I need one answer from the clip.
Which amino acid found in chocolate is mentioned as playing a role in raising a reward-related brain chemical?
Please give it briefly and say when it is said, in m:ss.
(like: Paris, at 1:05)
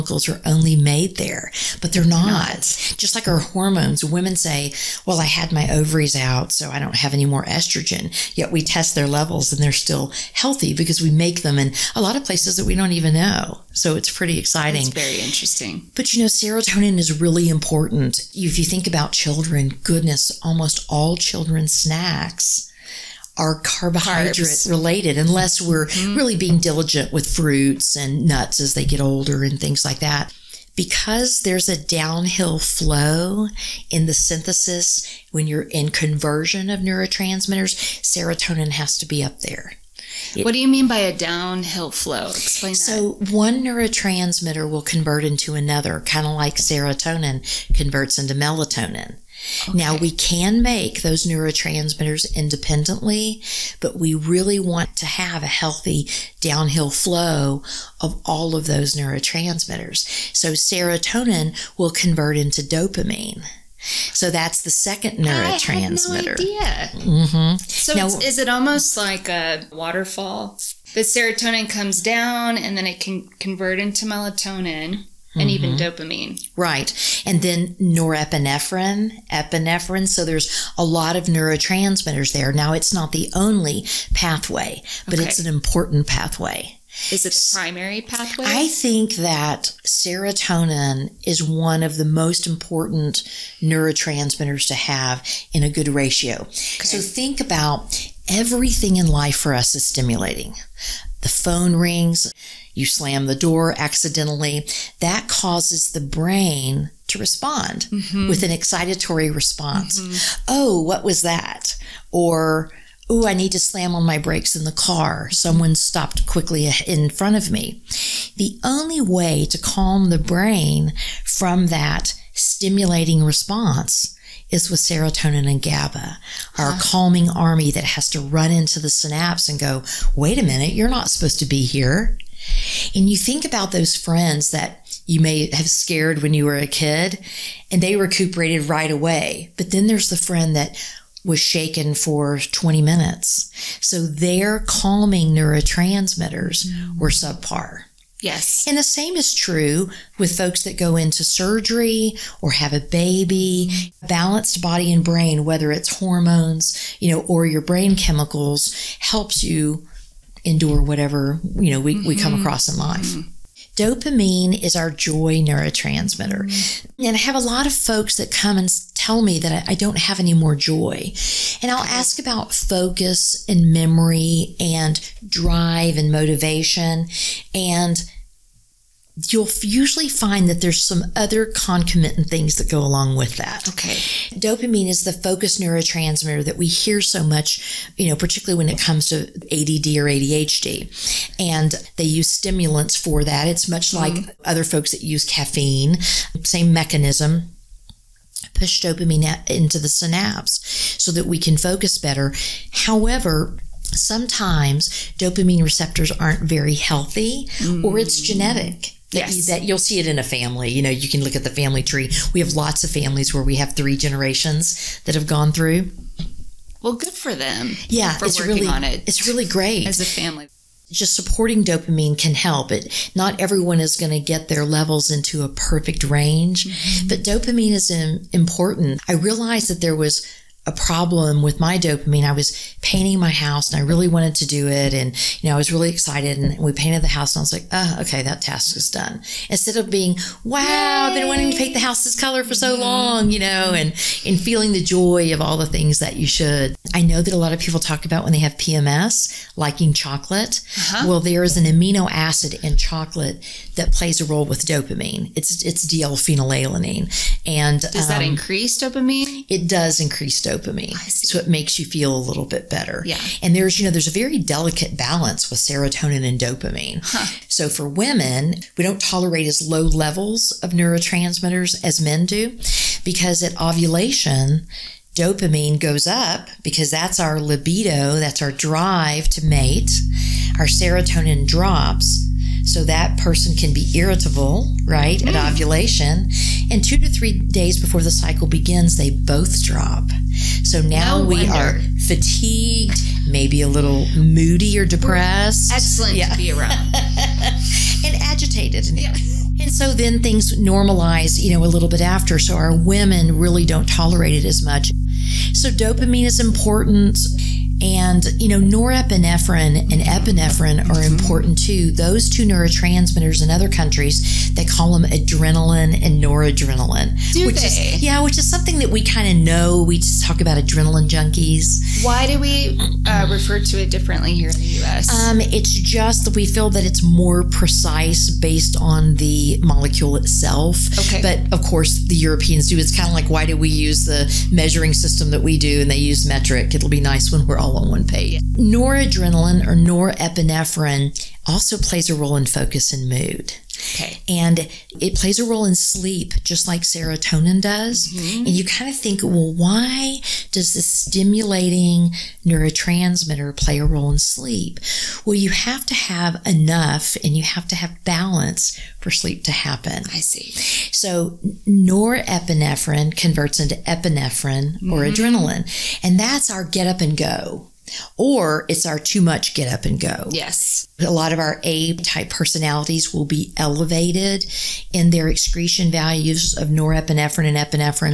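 D-L phenylalanine, at 4:15.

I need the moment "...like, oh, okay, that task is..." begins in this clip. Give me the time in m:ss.
3:57.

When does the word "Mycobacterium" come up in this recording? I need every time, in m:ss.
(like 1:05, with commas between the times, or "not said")
not said.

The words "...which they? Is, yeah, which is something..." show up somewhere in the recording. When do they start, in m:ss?
5:17.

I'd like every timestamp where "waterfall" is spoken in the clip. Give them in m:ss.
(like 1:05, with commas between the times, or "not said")
1:09.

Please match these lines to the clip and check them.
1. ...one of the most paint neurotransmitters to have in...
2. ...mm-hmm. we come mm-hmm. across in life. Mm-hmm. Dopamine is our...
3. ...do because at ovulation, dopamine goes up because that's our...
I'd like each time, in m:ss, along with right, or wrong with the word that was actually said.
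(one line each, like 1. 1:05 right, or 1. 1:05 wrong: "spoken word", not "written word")
1. 1:31 wrong: "important", not "paint"
2. 2:41 right
3. 4:32 right.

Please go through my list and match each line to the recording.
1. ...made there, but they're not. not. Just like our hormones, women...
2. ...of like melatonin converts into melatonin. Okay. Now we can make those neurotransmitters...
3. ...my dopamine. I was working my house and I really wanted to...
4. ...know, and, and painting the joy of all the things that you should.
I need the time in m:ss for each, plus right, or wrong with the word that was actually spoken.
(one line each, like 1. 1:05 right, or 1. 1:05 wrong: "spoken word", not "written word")
1. 0:00 right
2. 0:46 wrong: "serotonin", not "melatonin"
3. 3:51 wrong: "painting", not "working"
4. 4:03 wrong: "feeling", not "painting".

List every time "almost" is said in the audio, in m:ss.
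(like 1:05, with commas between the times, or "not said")
0:20, 1:08.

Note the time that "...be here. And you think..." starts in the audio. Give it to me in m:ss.
2:11.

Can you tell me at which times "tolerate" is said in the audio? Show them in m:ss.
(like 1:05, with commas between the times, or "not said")
4:29, 5:03.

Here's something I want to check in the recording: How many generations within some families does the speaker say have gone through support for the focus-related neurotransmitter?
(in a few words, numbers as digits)
3.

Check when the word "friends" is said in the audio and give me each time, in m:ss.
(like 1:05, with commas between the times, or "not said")
2:13, 2:20.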